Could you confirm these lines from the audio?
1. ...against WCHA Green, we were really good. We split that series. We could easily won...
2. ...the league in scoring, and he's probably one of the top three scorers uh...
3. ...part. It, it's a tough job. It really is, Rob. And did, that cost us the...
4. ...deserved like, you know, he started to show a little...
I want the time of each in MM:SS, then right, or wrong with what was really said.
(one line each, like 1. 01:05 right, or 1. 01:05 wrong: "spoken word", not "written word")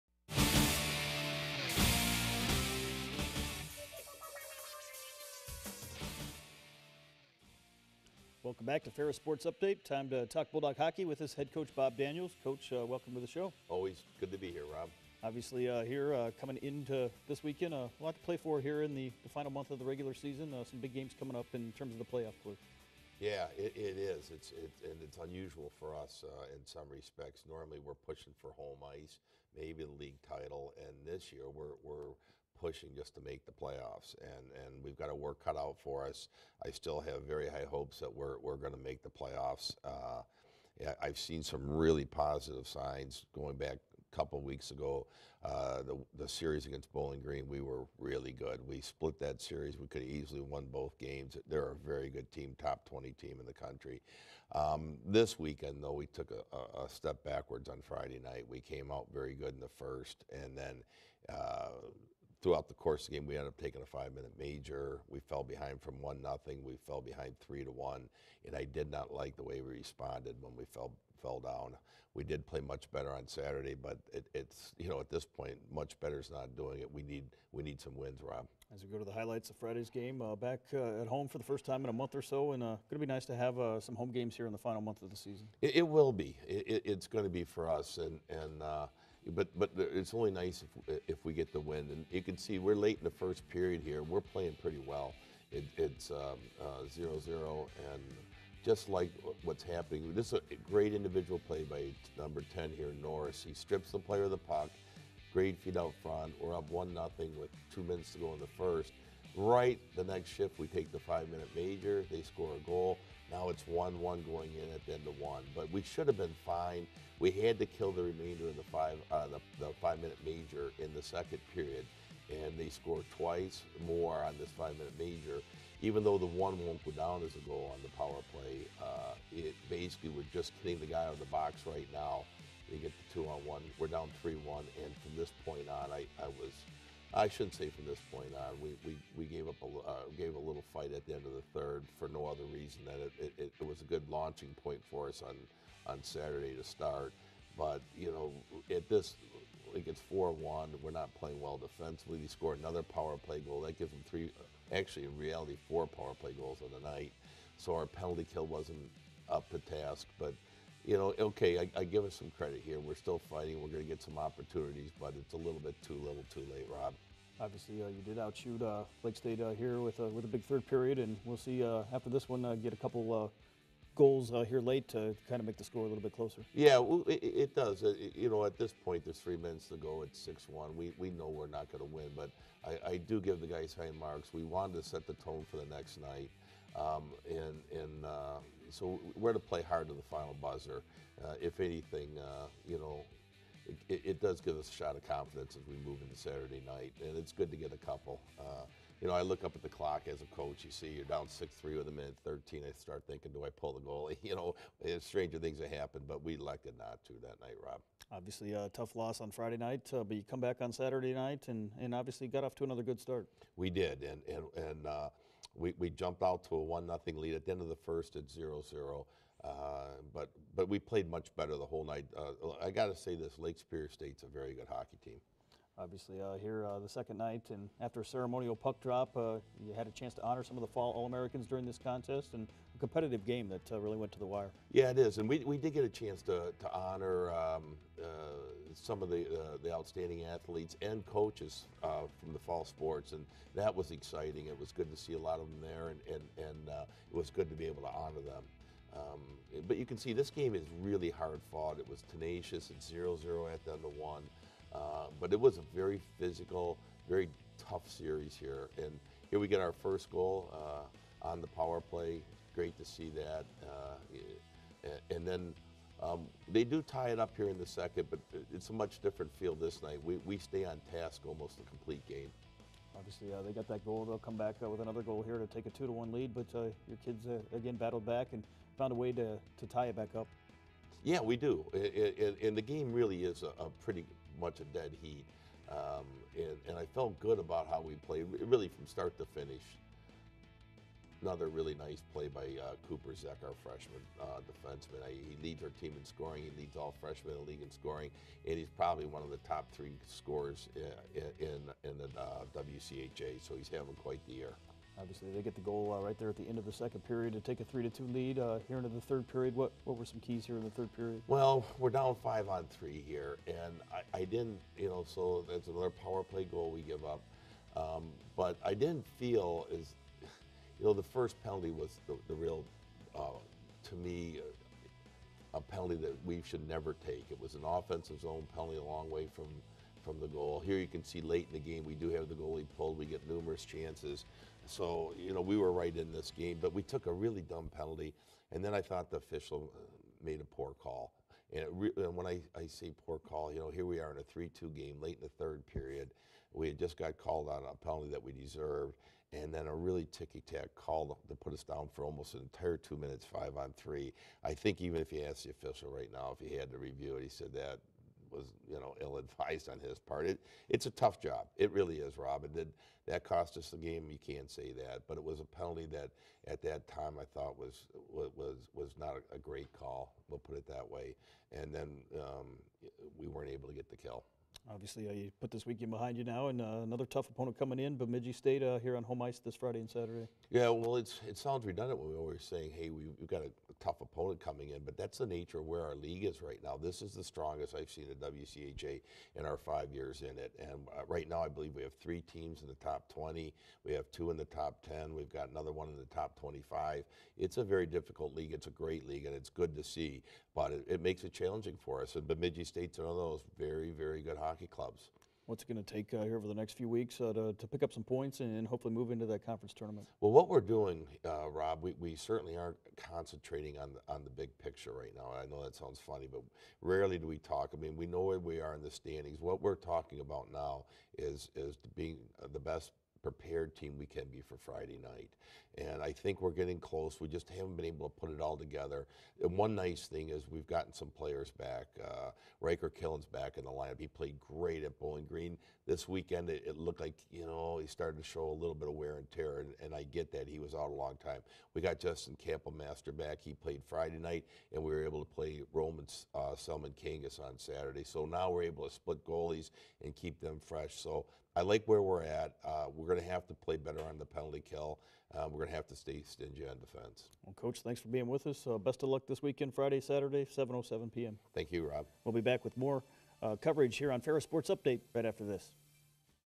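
1. 00:46 wrong: "Bowling", not "WCHA"
2. 04:57 right
3. 05:59 right
4. 07:16 wrong: "looked", not "deserved".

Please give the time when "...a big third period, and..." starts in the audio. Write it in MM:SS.
02:50.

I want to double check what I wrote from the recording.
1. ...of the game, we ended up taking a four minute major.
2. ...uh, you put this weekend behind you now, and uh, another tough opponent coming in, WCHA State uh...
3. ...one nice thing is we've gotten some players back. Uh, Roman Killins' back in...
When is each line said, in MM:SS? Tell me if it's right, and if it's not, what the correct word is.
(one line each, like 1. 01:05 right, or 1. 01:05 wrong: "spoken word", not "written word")
1. 01:03 wrong: "five", not "four"
2. 06:15 wrong: "Bemidji", not "WCHA"
3. 07:09 wrong: "Ryker", not "Roman".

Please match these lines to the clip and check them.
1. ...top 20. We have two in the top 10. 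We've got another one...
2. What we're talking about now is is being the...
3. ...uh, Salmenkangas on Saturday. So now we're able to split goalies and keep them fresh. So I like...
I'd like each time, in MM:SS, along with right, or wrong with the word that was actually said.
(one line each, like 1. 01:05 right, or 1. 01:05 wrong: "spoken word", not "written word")
1. 06:32 right
2. 06:59 right
3. 07:26 right.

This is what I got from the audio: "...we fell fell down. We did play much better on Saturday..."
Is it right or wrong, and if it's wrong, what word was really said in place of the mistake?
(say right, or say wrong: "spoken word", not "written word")
right.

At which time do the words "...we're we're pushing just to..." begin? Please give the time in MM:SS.
00:31.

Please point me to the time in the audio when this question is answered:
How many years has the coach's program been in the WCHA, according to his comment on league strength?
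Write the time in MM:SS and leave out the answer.
06:29.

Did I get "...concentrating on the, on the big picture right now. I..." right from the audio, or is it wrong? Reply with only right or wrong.
right.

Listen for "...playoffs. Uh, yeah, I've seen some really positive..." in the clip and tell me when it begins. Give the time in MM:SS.
00:39.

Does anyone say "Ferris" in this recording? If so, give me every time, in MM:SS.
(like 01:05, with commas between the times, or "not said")
00:08, 07:44.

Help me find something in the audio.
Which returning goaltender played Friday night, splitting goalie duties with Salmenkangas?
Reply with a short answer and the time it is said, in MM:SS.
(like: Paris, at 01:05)
Justin Kapelmaster, at 07:21.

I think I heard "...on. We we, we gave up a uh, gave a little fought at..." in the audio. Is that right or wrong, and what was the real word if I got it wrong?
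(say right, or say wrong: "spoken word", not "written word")
wrong: "fight", not "fought".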